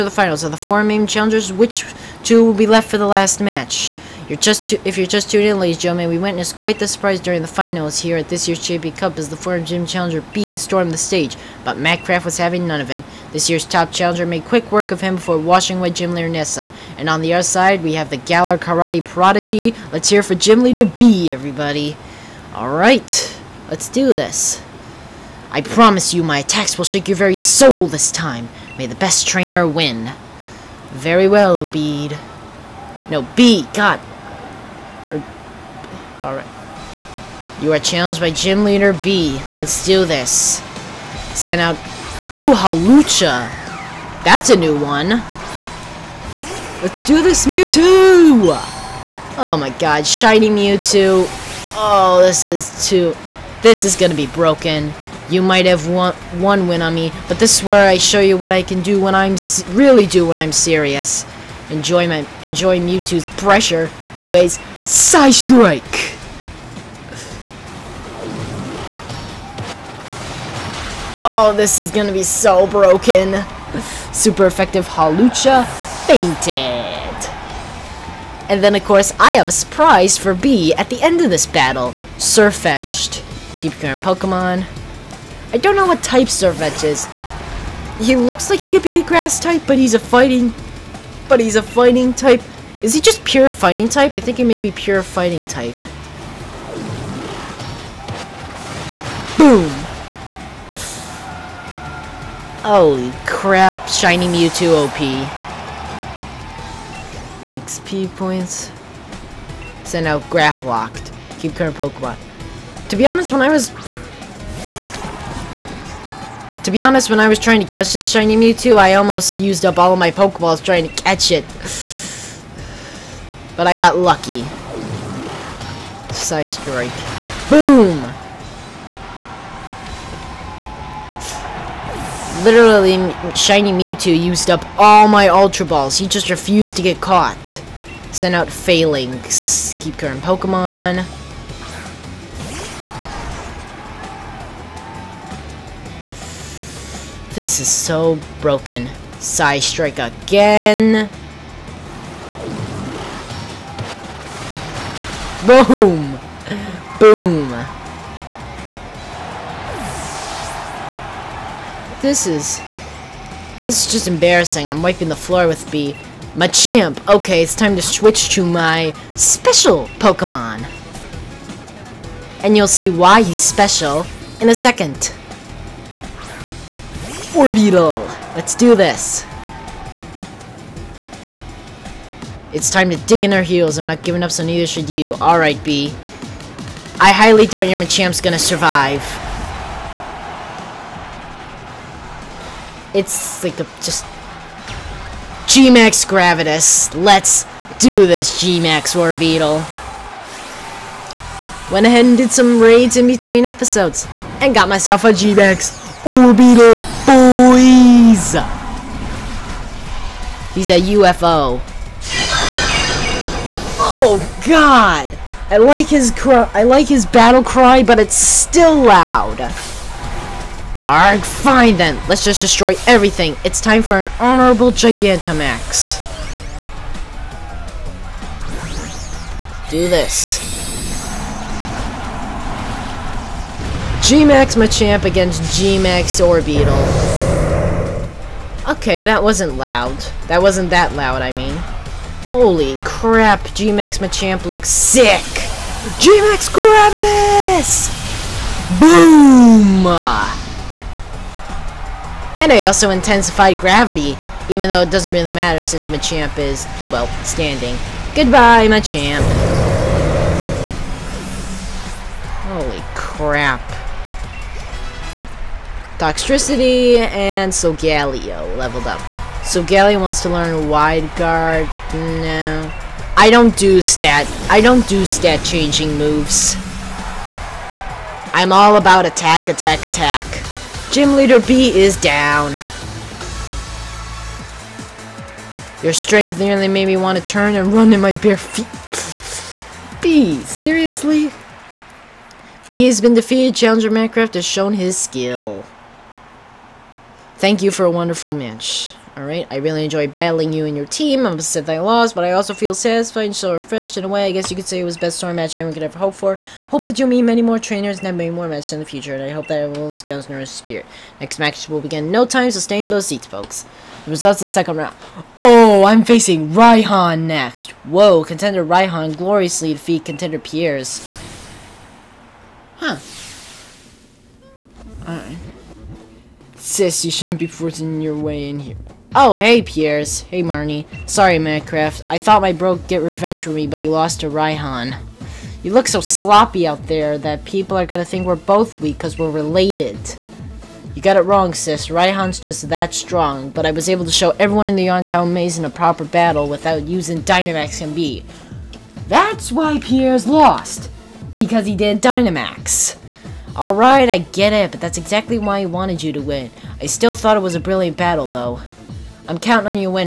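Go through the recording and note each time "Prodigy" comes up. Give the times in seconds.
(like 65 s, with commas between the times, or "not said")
19 s.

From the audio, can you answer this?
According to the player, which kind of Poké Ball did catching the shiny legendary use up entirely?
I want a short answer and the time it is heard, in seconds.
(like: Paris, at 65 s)
Ultra Balls, at 135 s.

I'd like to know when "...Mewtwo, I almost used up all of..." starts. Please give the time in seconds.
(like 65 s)
118 s.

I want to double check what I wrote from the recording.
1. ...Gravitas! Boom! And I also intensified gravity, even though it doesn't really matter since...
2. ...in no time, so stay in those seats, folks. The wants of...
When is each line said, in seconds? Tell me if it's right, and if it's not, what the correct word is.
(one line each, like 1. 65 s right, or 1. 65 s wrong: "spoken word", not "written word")
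1. 246 s right
2. 312 s wrong: "results", not "wants".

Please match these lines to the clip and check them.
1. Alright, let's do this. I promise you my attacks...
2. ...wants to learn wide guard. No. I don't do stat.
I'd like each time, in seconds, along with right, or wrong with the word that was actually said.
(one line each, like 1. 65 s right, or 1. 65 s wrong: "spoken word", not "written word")
1. 22 s right
2. 269 s right.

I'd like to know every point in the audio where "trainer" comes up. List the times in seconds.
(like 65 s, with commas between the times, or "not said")
29 s, 307 s.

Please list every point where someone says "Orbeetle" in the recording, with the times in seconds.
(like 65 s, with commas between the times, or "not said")
198 s, 206 s, 236 s.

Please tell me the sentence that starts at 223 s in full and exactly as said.
It's time for an honorable Gigantamax.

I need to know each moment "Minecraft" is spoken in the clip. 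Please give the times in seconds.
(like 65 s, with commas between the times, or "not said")
293 s, 331 s.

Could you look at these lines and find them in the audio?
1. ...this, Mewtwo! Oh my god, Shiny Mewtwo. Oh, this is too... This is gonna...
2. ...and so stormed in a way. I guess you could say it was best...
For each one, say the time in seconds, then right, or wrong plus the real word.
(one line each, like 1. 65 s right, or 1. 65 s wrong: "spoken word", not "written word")
1. 47 s right
2. 303 s wrong: "refreshed", not "stormed".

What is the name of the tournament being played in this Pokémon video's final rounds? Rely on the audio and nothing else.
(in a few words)
JB Cup.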